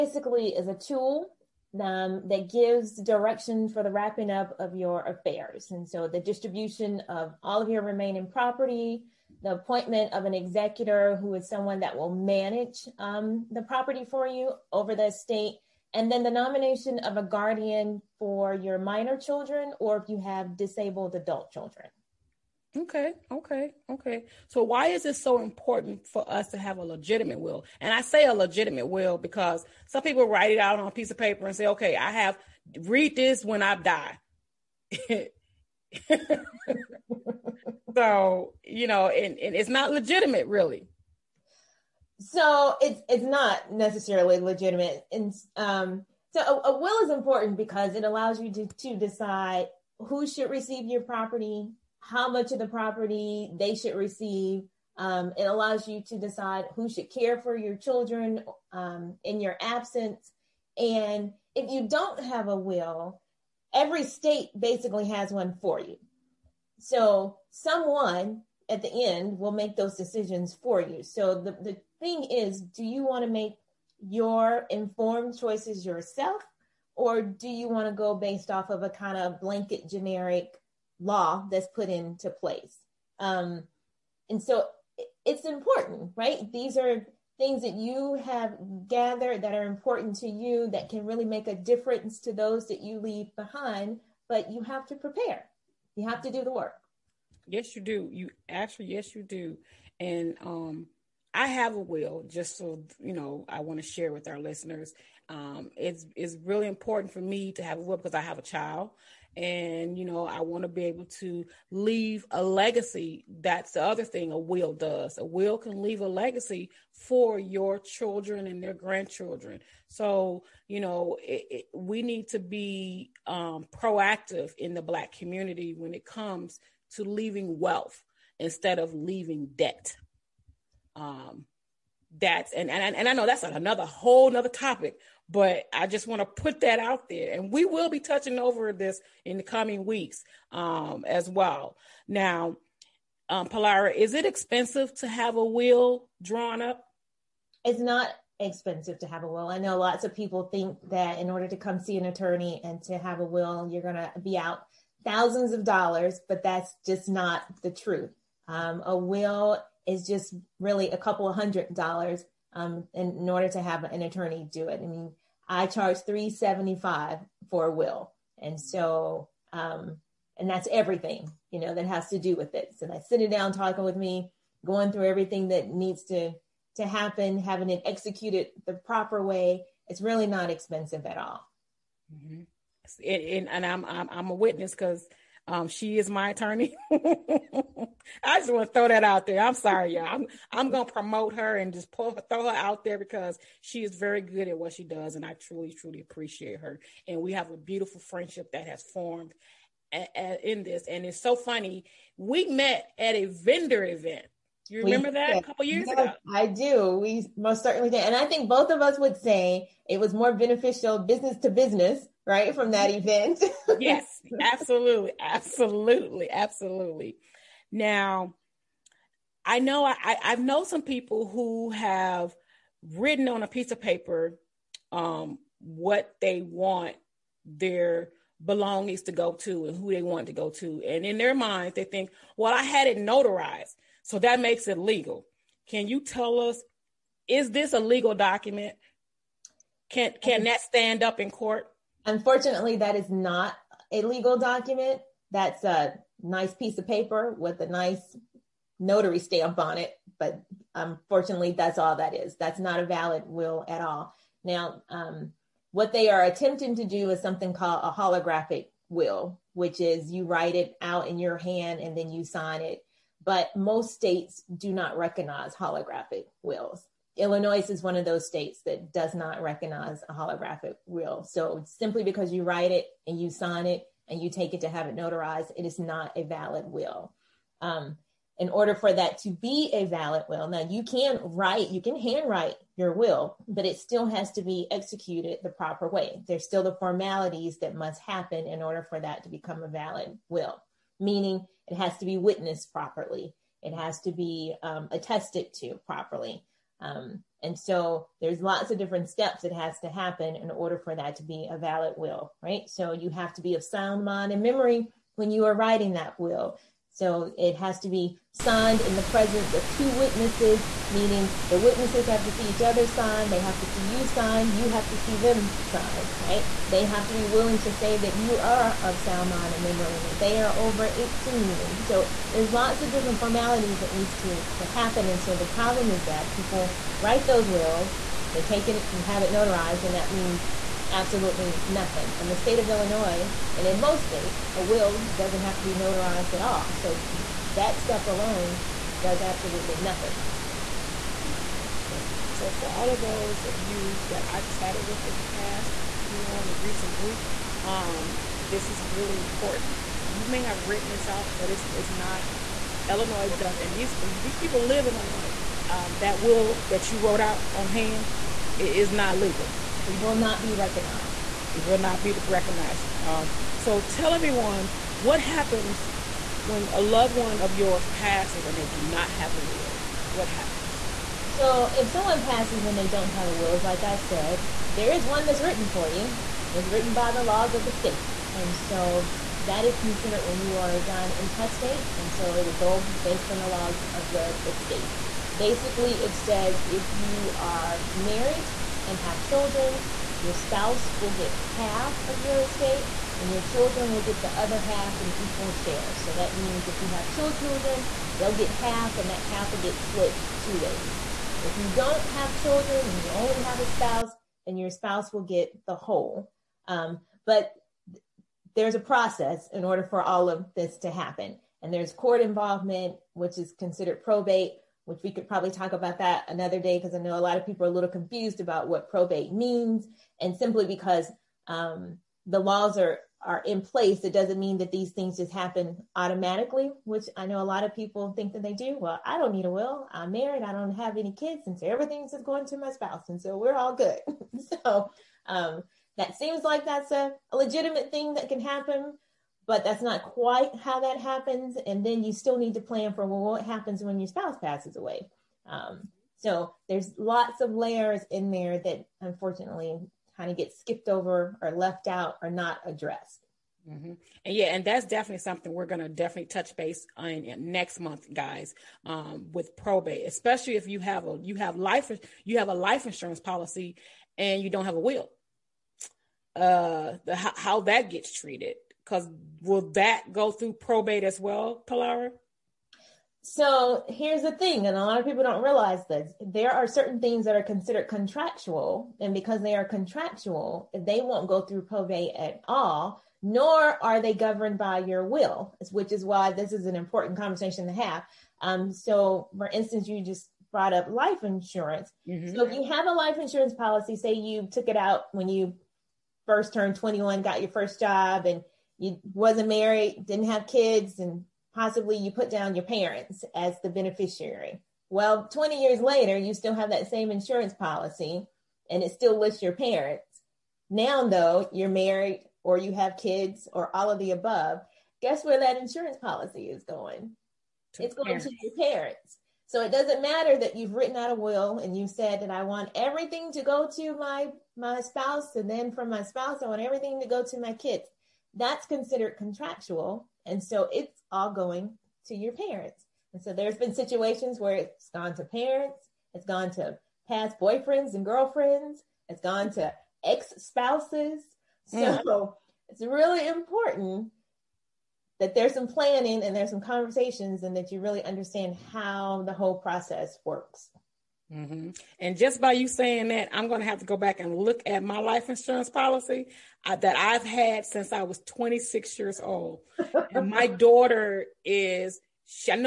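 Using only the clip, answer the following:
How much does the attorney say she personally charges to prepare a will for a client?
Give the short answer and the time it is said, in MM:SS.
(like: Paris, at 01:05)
$375, at 02:46.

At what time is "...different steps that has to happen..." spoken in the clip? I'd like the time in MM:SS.
04:58.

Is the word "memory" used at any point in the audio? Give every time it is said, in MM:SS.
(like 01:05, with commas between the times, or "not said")
05:04, 05:19.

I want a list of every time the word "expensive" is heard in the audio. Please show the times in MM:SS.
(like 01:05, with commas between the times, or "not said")
02:24, 02:28, 03:00.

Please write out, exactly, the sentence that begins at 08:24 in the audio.
Well, 20 years later, you still have that same insurance policy and it still lists your parents.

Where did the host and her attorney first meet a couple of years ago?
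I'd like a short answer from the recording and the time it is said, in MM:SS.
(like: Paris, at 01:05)
A vendor event, at 03:23.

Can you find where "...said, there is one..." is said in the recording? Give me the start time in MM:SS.
06:13.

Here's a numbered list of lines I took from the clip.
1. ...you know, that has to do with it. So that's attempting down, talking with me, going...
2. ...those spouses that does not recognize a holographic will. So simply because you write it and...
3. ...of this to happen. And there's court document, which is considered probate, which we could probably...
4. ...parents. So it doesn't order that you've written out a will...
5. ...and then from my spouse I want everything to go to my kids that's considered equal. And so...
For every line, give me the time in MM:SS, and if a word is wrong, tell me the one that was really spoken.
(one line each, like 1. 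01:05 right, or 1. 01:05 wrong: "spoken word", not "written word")
1. 02:51 wrong: "sitting", not "attempting"
2. 04:28 wrong: "states", not "spouses"
3. 06:50 wrong: "involvement", not "document"
4. 08:38 wrong: "matter", not "order"
5. 08:45 wrong: "contractual", not "equal".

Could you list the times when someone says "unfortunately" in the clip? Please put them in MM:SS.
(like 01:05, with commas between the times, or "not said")
04:02, 04:10, 07:29.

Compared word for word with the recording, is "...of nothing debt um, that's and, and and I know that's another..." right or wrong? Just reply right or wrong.
wrong.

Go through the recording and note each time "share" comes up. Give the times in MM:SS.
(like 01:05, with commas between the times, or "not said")
01:43, 06:35.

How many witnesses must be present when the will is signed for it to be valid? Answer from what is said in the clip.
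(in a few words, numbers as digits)
2.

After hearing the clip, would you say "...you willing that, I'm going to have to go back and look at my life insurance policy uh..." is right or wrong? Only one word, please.
wrong.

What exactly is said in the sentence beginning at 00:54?
Um, it allows you to decide who should care for your children um, in your absence.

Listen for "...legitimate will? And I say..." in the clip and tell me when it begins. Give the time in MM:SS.
00:26.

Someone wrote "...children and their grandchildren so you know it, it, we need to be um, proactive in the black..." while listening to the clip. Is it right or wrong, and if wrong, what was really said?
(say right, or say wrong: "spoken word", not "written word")
right.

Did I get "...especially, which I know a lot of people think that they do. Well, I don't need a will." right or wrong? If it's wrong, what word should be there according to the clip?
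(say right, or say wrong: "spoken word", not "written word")
wrong: "automatically", not "especially".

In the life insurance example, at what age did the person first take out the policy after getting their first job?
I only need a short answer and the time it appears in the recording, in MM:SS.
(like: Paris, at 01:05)
21, at 08:16.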